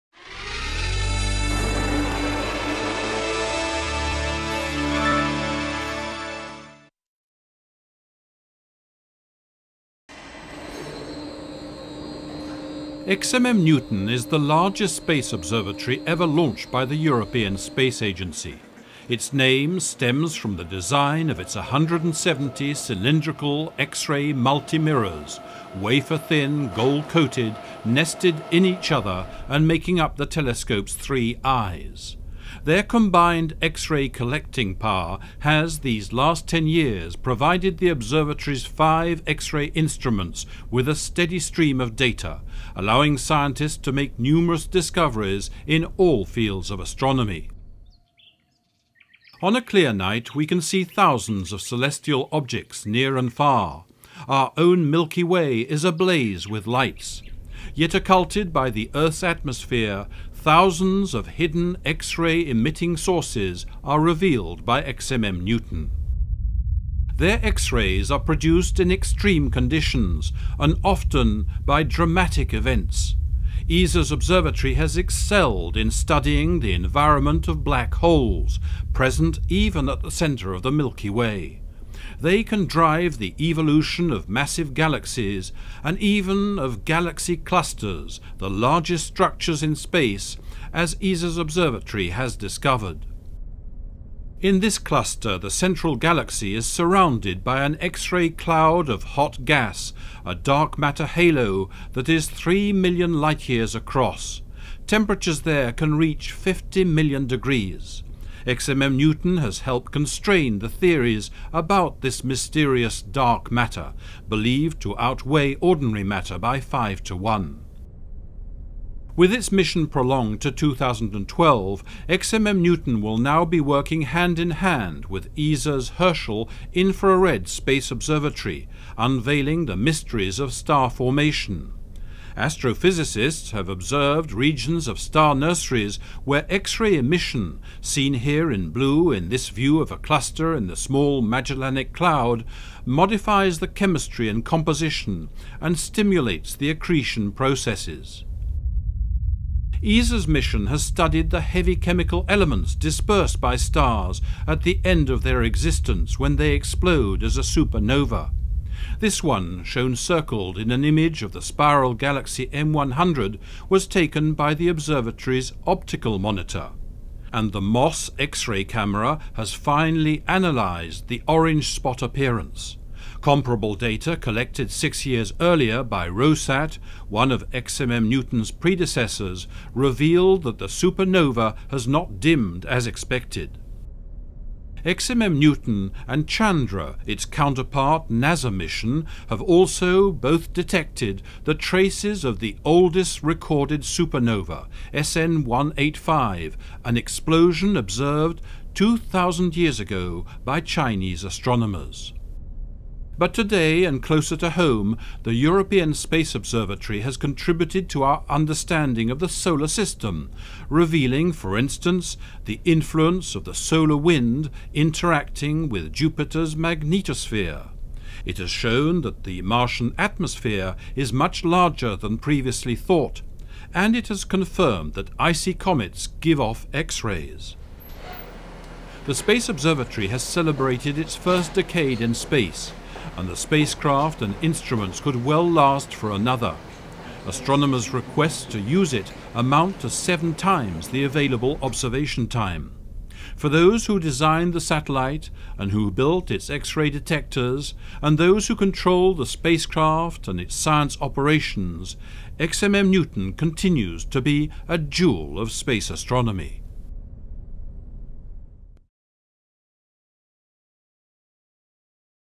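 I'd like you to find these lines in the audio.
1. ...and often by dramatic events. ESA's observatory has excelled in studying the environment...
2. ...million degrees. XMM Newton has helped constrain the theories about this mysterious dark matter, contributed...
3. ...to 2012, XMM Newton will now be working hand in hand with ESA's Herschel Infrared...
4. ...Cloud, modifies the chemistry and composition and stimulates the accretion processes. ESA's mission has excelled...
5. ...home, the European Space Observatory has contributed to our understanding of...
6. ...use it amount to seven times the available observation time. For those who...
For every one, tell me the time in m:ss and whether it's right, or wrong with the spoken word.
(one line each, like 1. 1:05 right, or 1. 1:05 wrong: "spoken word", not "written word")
1. 1:10 right
2. 1:46 wrong: "believed", not "contributed"
3. 2:00 right
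4. 2:21 wrong: "studied", not "excelled"
5. 3:24 right
6. 3:58 right.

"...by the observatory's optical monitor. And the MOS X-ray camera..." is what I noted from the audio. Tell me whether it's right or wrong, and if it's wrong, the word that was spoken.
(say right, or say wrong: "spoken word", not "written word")
right.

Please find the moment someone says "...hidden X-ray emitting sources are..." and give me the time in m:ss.
1:01.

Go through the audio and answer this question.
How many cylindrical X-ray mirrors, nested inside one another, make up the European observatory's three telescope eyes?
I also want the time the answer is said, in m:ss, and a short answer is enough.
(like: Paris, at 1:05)
170, at 0:21.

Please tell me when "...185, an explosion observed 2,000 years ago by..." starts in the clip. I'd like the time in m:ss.
3:15.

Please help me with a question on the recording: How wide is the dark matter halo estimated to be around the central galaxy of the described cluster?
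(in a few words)
3 million light-years.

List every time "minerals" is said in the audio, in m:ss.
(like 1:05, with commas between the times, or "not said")
not said.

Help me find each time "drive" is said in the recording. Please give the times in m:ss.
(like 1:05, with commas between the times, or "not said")
1:22.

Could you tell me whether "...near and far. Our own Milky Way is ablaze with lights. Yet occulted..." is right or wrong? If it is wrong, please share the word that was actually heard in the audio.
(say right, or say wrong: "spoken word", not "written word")
right.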